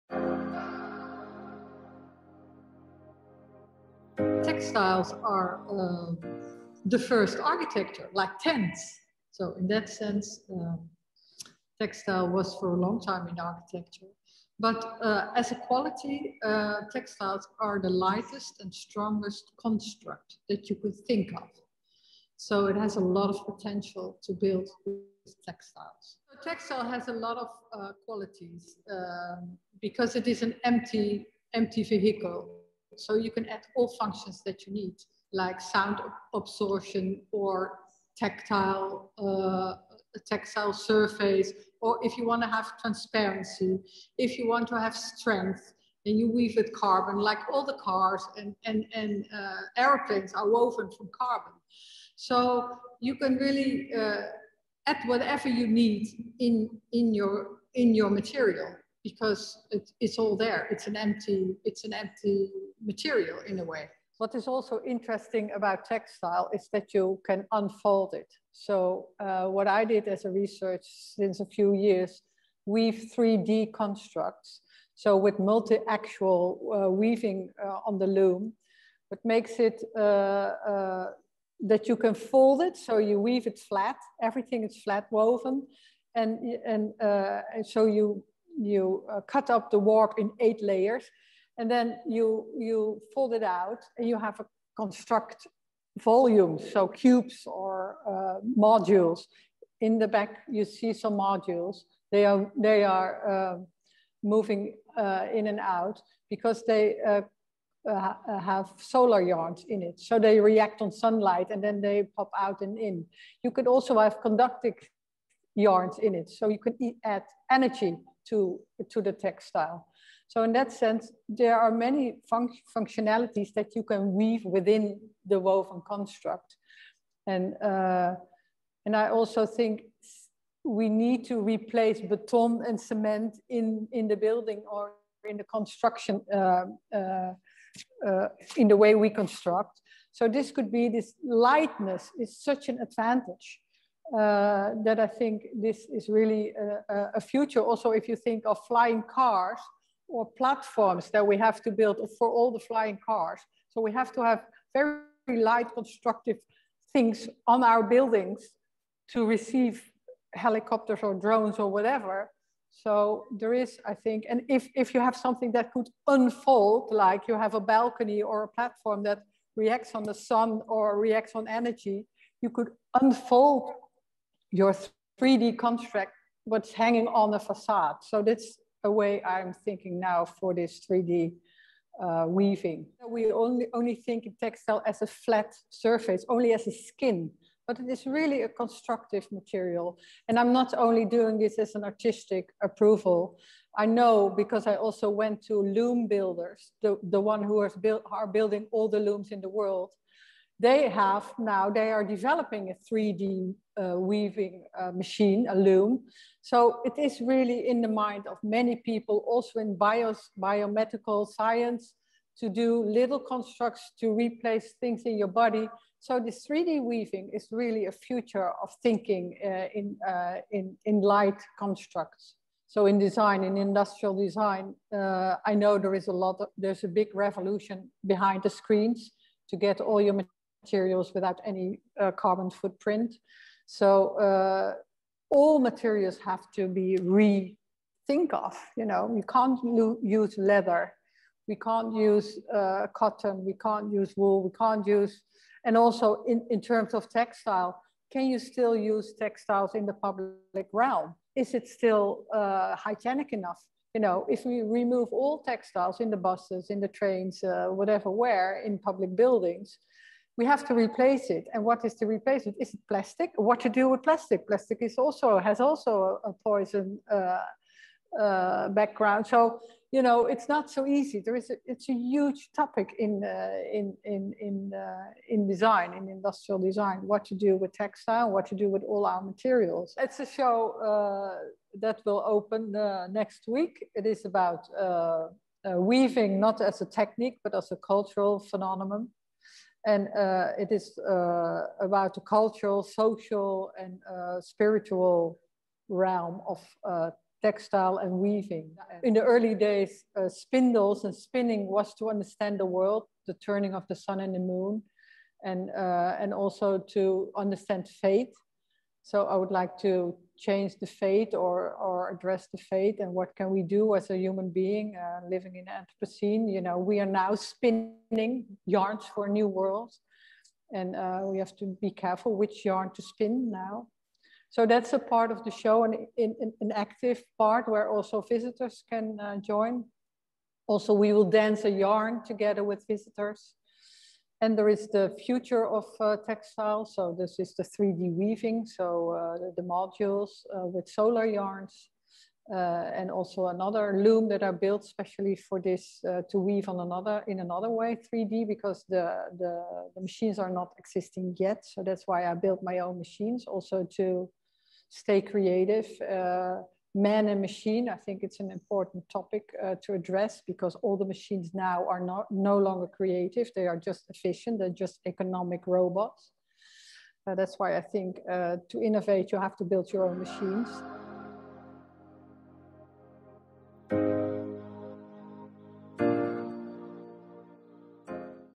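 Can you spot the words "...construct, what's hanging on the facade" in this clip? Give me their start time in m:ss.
2:55.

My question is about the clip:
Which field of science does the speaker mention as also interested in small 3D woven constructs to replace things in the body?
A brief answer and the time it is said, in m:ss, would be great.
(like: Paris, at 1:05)
Biomedical science, at 3:30.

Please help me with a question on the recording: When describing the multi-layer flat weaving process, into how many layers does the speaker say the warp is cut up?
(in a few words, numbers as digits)
8.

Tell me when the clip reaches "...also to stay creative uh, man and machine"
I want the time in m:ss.
5:53.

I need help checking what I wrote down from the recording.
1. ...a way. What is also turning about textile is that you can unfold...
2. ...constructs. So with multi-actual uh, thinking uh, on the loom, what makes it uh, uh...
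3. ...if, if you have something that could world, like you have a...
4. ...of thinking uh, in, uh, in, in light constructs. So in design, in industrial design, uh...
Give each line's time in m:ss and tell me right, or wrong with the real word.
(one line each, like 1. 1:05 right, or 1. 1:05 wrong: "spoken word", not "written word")
1. 1:03 wrong: "interesting", not "turning"
2. 1:13 wrong: "weaving", not "thinking"
3. 2:44 wrong: "unfold", not "world"
4. 3:38 right.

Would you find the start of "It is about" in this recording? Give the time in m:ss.
4:43.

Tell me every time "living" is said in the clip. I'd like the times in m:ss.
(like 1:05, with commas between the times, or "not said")
5:15.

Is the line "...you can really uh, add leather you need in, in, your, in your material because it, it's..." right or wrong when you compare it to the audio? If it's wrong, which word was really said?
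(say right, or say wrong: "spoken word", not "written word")
wrong: "whatever", not "leather".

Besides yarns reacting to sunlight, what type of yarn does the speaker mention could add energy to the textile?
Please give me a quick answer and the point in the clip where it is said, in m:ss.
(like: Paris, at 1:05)
Conductive yarns, at 1:54.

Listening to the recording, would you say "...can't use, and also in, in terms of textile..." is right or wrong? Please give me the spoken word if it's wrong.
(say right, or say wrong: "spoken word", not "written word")
right.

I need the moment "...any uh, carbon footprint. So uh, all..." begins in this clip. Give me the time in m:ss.
3:51.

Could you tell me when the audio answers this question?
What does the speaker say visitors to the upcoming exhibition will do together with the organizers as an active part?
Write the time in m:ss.
5:31.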